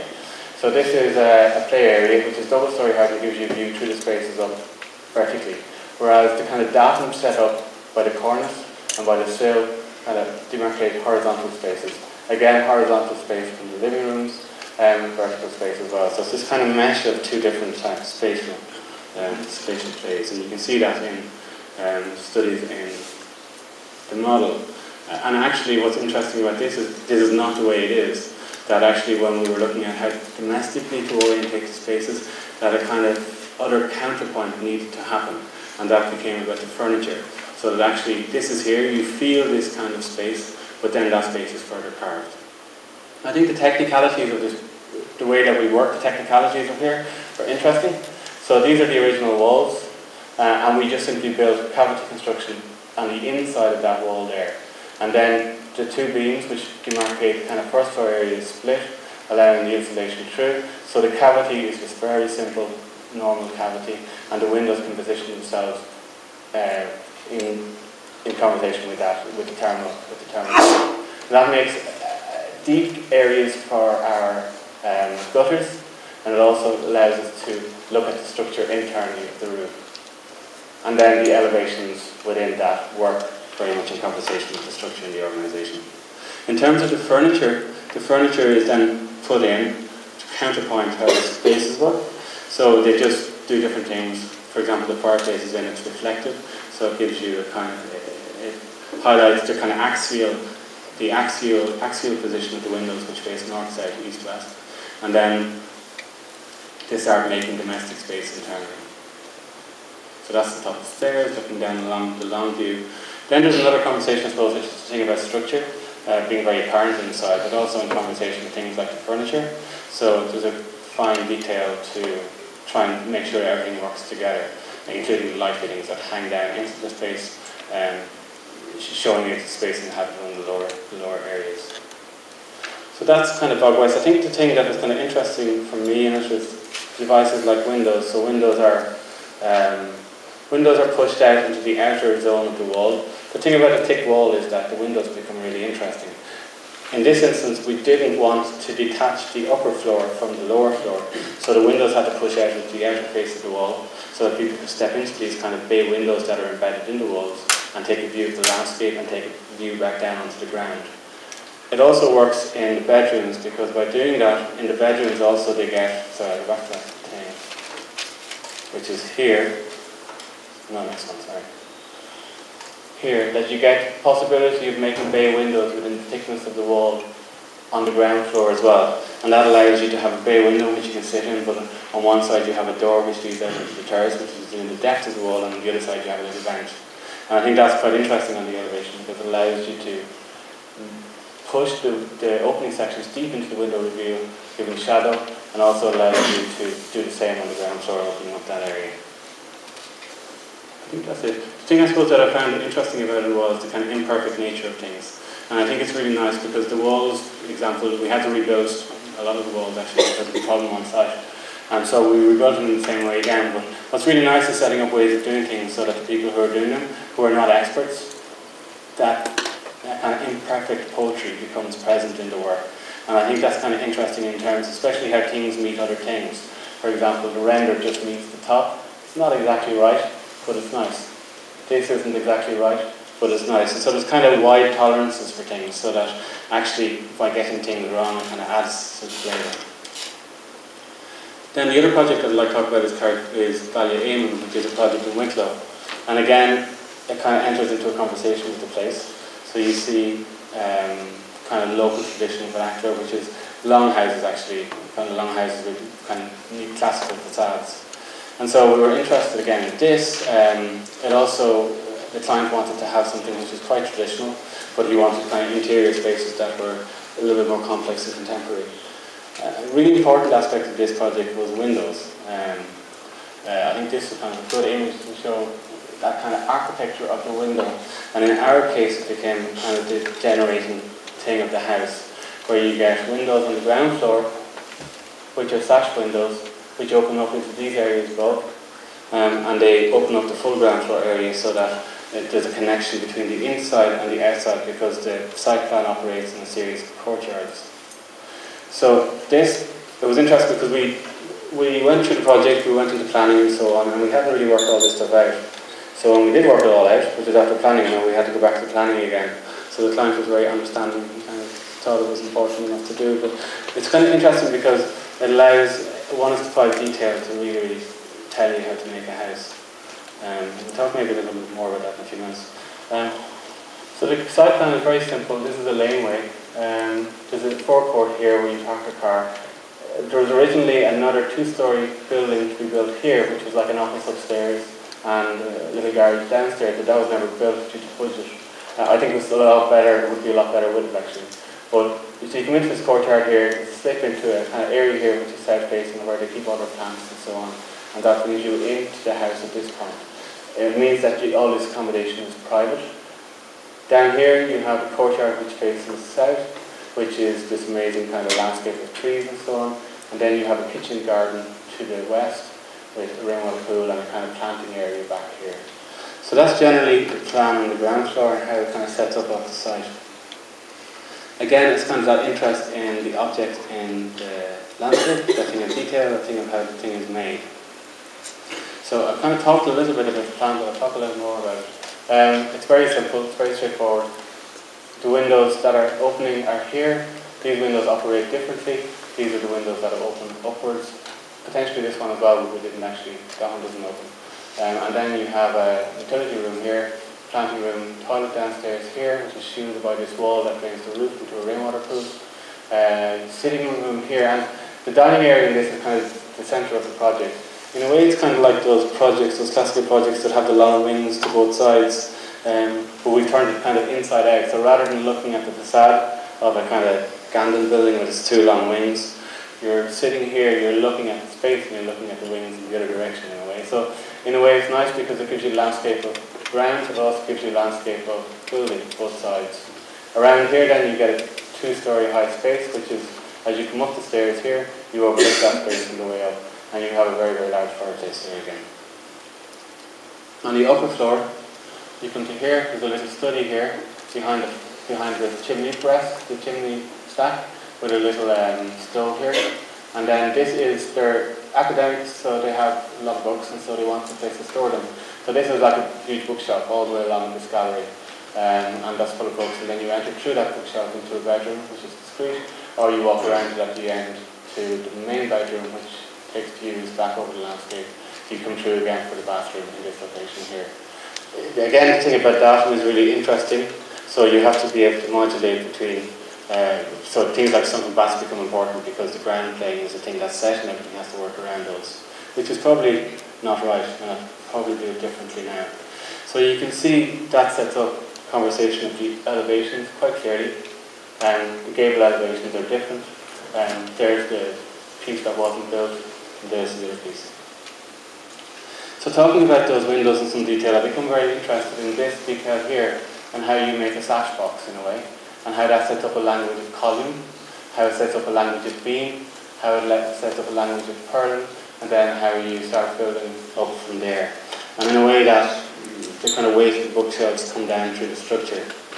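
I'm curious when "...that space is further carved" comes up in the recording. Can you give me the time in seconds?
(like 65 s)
41 s.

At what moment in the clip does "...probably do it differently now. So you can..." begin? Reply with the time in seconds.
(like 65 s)
484 s.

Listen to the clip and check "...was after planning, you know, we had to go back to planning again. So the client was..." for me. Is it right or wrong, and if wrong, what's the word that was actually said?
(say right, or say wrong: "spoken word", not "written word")
right.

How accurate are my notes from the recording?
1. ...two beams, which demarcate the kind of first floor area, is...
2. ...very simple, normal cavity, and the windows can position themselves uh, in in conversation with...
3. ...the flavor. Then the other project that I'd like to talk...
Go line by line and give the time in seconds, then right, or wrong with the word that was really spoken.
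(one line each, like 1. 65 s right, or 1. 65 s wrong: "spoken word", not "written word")
1. 55 s right
2. 61 s right
3. 239 s right.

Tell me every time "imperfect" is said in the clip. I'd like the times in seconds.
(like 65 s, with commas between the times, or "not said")
203 s, 220 s.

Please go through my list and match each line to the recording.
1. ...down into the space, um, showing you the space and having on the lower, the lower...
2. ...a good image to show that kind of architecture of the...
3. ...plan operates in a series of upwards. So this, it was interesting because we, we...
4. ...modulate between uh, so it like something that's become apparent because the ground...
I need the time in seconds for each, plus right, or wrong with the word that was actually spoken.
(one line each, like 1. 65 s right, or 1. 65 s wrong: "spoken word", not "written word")
1. 126 s right
2. 274 s right
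3. 295 s wrong: "courtyards", not "upwards"
4. 475 s wrong: "important", not "apparent".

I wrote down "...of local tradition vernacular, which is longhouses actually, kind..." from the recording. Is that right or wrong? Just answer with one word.
right.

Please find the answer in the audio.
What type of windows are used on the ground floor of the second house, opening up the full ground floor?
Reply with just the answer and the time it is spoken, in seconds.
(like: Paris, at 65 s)
sash windows, at 285 s.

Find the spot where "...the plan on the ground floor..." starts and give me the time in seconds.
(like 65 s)
367 s.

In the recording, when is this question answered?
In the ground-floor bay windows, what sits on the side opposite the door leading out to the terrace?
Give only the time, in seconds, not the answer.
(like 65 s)
186 s.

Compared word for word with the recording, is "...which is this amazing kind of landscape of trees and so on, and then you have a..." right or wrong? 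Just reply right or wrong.
right.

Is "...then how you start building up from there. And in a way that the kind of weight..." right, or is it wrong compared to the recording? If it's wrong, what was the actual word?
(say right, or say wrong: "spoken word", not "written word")
right.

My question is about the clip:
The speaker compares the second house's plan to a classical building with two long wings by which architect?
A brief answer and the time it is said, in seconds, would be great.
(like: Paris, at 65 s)
Gandon, at 417 s.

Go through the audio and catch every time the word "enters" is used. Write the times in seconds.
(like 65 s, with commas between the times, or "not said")
247 s, 459 s.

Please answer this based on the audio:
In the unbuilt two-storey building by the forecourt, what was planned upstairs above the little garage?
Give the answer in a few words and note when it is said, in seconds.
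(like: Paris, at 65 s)
an office, at 333 s.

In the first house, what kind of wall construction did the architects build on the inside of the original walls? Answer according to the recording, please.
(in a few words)
cavity construction.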